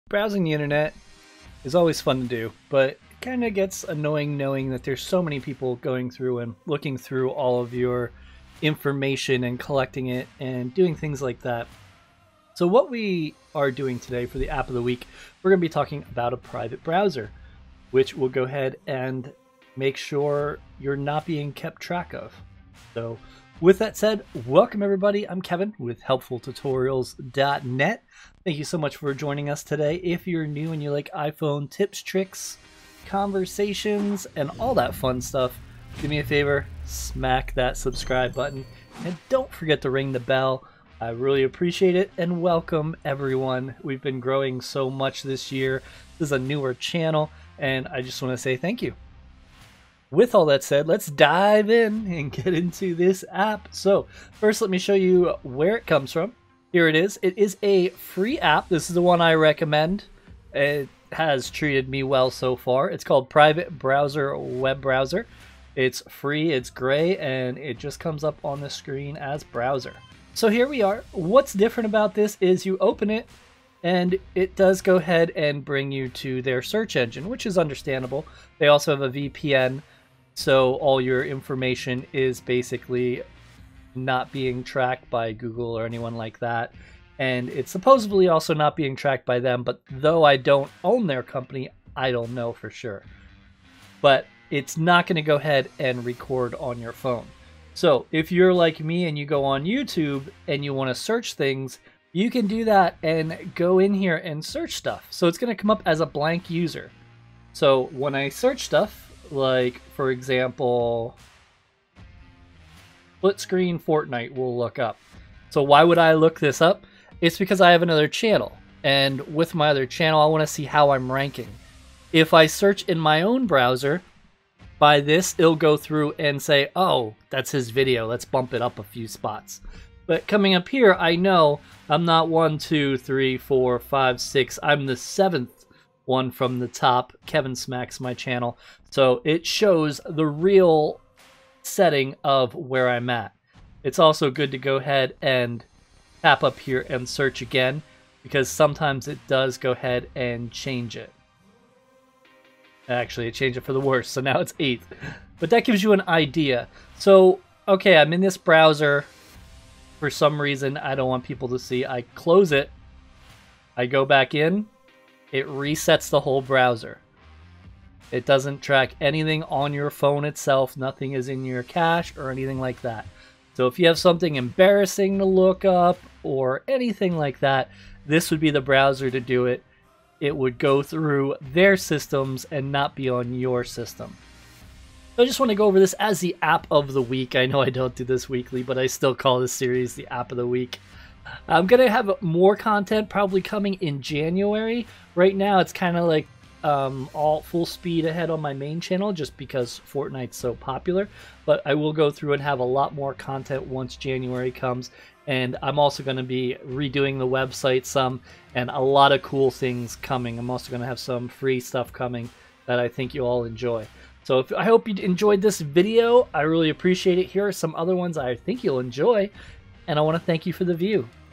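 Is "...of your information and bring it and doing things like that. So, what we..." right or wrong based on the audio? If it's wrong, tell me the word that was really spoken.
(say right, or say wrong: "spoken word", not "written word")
wrong: "collecting", not "bring".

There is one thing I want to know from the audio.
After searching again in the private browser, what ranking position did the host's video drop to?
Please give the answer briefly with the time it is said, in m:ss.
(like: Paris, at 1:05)
8th, at 2:34.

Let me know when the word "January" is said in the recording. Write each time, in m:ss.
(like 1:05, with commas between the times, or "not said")
3:14, 3:23.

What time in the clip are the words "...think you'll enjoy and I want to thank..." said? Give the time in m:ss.
3:38.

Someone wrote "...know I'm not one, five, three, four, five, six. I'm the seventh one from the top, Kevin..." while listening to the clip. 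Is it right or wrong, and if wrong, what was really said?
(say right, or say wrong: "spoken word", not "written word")
wrong: "two", not "five".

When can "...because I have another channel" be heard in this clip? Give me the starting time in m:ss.
1:57.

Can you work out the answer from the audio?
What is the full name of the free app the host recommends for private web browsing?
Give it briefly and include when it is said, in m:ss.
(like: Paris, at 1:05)
Private Browser Web Browser, at 1:03.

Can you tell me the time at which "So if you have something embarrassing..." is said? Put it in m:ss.
2:53.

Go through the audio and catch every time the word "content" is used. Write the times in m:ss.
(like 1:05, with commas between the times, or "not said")
3:12, 3:23.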